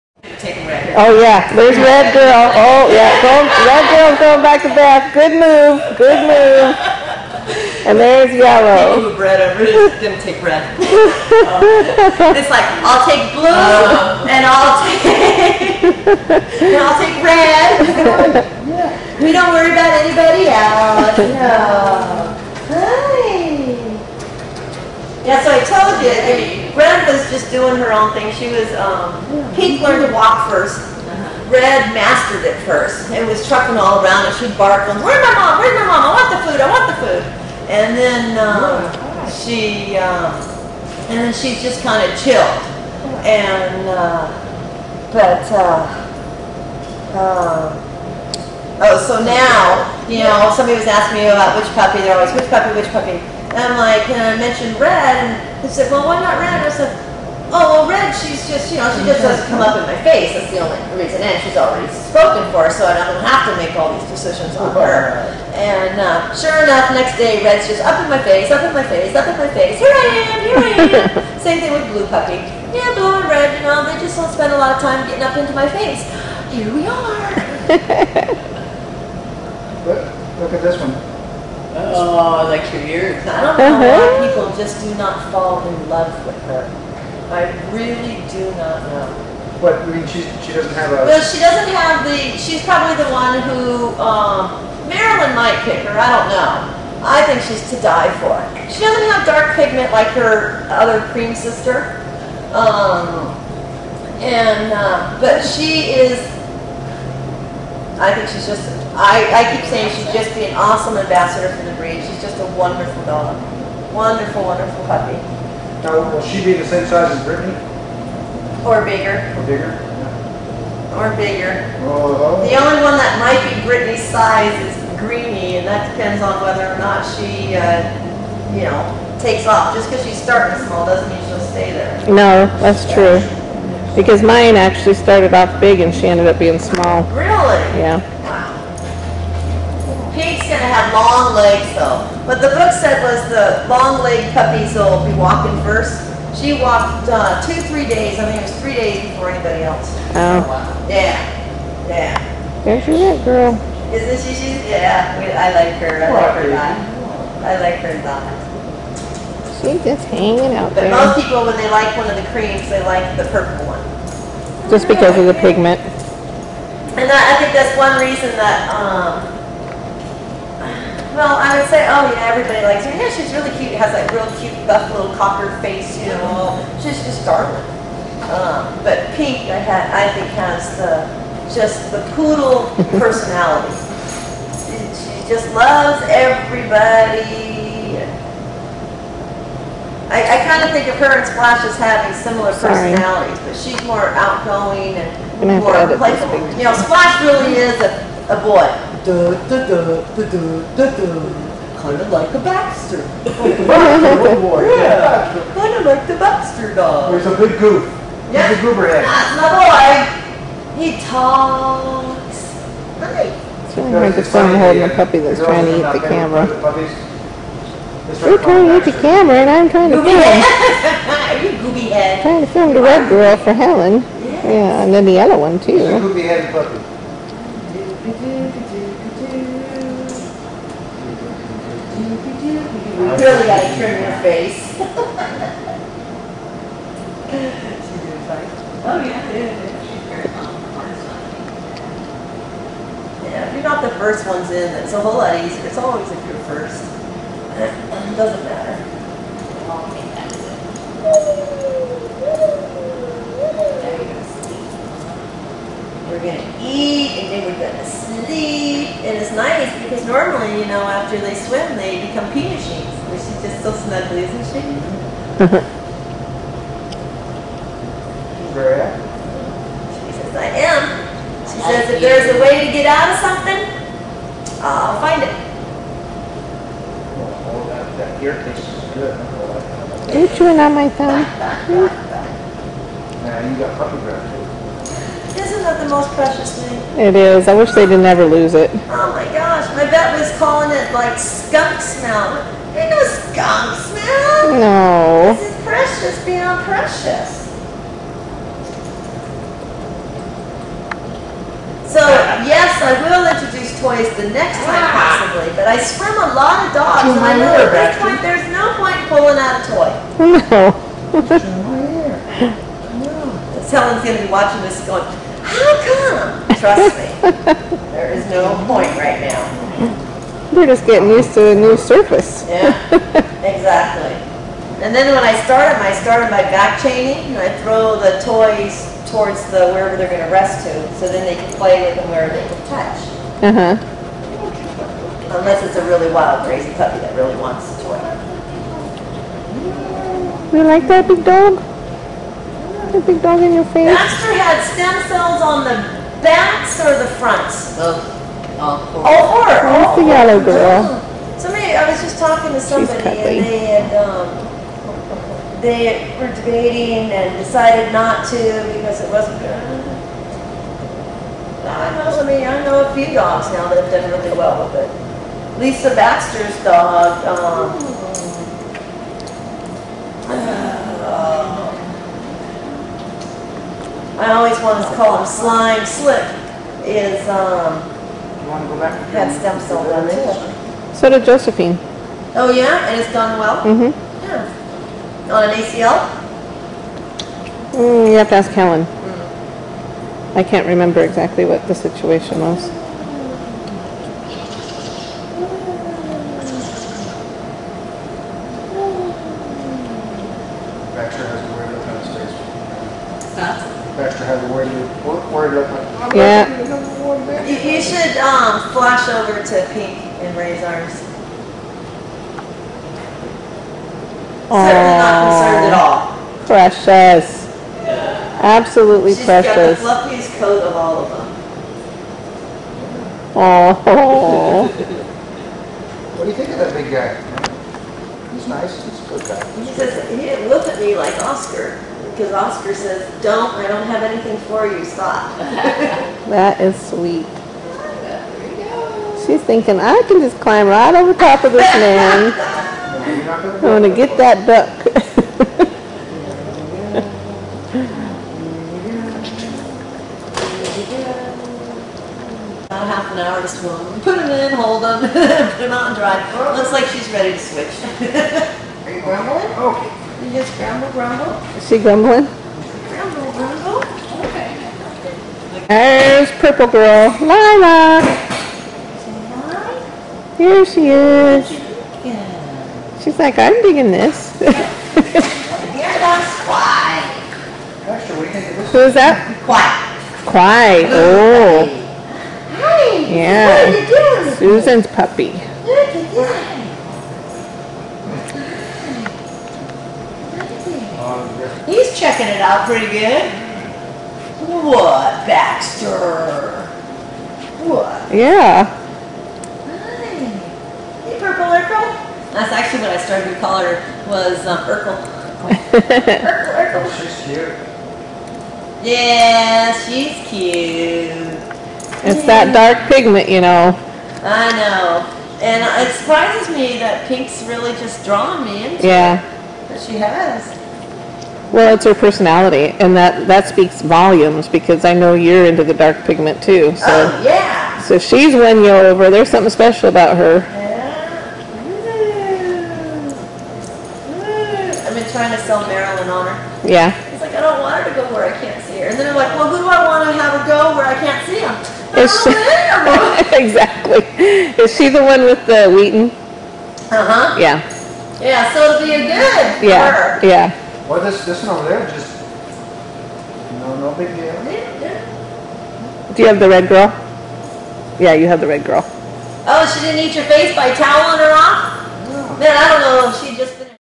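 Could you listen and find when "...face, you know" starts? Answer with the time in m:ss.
2:55.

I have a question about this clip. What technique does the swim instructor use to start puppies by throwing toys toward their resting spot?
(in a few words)
Back chaining.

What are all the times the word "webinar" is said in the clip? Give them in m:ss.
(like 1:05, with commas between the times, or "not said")
not said.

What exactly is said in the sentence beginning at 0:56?
I said, oh, well, red, she's just, you know, she just doesn't come up in my face.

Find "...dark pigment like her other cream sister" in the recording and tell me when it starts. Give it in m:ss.
1:39.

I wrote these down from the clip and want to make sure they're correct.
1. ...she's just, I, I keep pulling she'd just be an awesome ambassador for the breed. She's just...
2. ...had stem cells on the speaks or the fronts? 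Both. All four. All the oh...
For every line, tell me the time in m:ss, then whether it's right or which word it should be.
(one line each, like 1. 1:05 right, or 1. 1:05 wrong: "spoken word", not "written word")
1. 1:48 wrong: "saying", not "pulling"
2. 5:44 wrong: "backs", not "speaks".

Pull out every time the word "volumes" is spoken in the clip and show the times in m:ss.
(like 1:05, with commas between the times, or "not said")
8:43.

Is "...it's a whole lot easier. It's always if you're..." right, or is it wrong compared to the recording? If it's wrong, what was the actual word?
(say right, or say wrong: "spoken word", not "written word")
right.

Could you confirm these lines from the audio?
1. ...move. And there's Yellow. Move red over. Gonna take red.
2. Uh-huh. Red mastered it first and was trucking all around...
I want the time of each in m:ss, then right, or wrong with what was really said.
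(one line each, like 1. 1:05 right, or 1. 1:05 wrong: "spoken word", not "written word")
1. 0:06 right
2. 0:30 right.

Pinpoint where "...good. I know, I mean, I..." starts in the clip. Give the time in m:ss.
5:59.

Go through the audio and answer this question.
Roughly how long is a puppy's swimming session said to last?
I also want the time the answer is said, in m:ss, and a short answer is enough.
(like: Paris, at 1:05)
Half an hour, at 7:32.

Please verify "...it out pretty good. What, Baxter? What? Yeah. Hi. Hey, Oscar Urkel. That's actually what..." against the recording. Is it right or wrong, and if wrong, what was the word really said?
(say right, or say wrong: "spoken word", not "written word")
wrong: "Purple", not "Oscar".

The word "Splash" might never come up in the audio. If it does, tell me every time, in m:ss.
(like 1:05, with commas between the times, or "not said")
3:11, 3:16.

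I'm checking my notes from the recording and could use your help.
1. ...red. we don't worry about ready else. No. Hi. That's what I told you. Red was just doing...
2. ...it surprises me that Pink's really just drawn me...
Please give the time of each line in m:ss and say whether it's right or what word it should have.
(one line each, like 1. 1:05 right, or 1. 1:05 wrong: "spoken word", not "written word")
1. 0:17 wrong: "anybody", not "ready"
2. 8:35 right.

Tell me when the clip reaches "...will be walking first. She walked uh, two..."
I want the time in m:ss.
2:24.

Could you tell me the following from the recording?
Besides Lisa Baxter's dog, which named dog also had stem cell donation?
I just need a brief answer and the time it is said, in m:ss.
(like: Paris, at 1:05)
Josephine, at 6:21.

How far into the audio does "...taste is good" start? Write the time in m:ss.
4:38.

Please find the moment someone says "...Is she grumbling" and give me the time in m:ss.
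7:41.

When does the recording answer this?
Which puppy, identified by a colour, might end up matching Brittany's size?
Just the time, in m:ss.
2:04.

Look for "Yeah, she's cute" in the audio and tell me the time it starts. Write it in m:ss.
8:28.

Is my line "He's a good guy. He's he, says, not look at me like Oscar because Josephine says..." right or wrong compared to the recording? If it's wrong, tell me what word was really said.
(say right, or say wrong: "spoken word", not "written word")
wrong: "Oscar", not "Josephine".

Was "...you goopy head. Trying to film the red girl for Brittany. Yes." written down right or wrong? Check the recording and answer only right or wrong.
wrong.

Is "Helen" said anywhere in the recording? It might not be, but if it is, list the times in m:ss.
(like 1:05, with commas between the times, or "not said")
3:43, 5:13, 6:28.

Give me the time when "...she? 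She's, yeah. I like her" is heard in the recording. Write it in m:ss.
2:34.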